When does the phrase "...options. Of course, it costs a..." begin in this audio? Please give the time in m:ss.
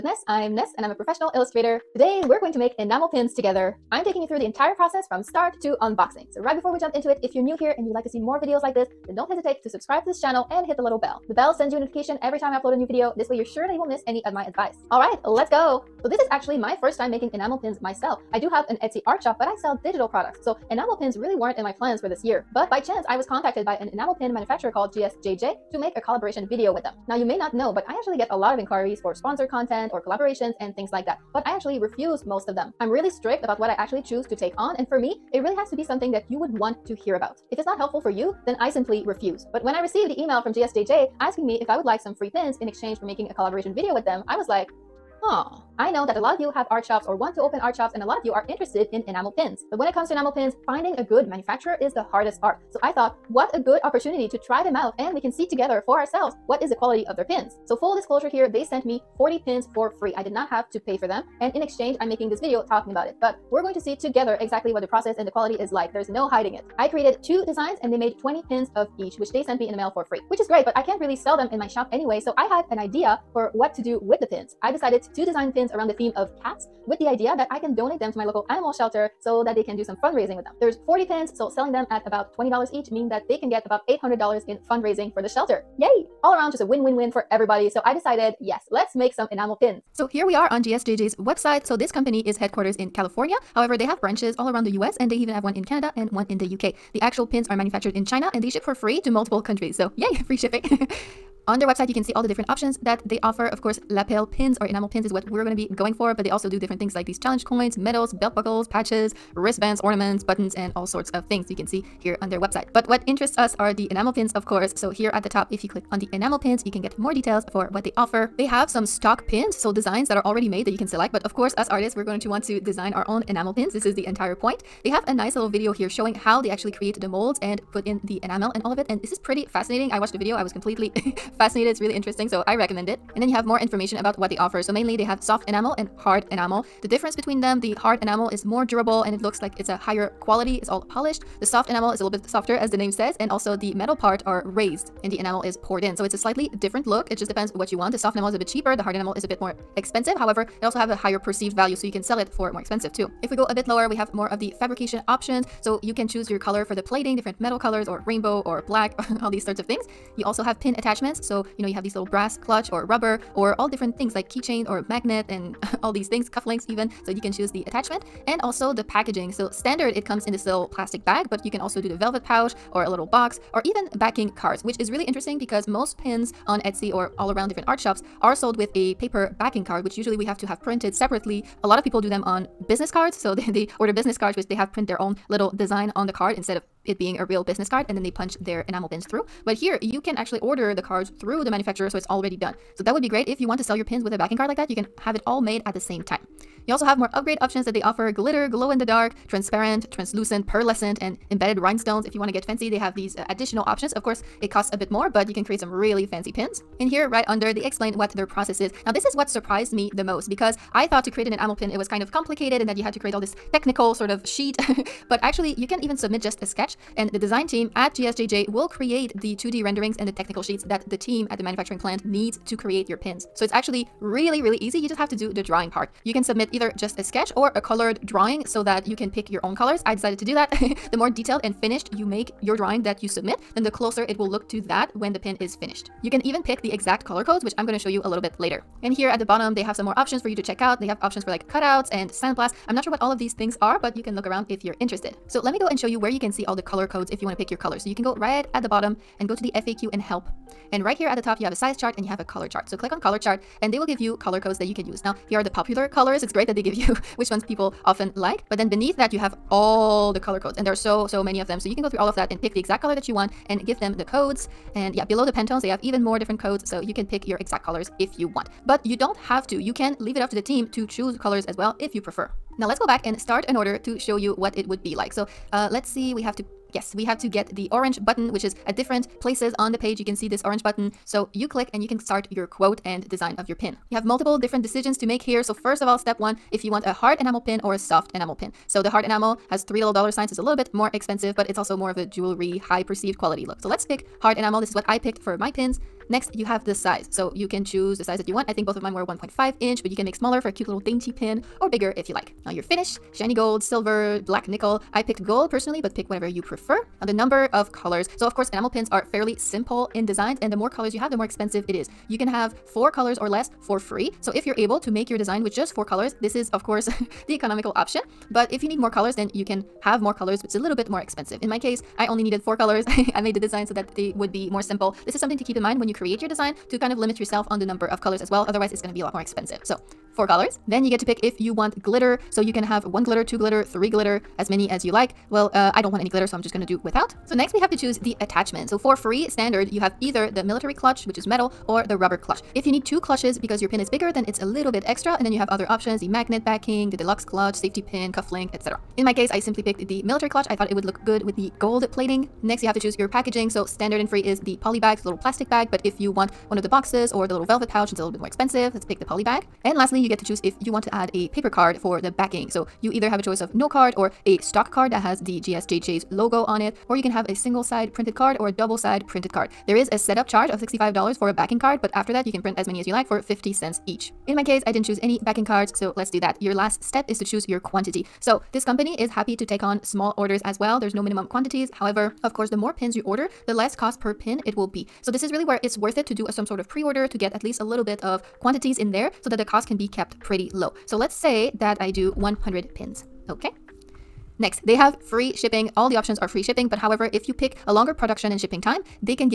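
3:23.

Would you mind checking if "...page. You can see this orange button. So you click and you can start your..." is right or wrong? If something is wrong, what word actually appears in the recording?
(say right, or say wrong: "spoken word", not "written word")
right.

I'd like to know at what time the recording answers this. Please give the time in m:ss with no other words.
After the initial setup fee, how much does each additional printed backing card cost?
6:13.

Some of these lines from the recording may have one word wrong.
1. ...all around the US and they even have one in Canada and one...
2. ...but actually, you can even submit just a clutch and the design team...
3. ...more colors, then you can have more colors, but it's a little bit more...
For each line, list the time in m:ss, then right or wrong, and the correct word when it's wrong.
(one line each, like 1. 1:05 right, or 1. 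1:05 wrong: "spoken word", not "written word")
1. 1:34 right
2. 3:35 wrong: "sketch", not "clutch"
3. 5:18 right.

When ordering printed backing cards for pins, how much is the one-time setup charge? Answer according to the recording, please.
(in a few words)
$65.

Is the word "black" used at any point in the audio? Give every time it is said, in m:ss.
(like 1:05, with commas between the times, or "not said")
2:38, 5:04.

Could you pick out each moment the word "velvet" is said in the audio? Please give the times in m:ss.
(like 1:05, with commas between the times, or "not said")
2:51, 5:57.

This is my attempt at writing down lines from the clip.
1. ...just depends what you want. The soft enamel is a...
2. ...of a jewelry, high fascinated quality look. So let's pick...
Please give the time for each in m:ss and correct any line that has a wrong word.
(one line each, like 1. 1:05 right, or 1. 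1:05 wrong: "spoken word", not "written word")
1. 2:27 right
2. 4:51 wrong: "perceived", not "fascinated".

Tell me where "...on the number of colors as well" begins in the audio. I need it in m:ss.
5:27.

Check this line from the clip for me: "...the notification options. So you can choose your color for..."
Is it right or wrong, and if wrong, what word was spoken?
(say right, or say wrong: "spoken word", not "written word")
wrong: "fabrication", not "notification".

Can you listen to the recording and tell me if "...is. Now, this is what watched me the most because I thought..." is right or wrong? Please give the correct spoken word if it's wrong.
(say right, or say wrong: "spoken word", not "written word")
wrong: "surprised", not "watched".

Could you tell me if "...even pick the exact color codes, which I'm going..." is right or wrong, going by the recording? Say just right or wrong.
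right.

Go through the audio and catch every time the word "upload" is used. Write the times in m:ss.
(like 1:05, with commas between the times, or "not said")
0:12.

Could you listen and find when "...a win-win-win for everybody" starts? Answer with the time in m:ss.
1:26.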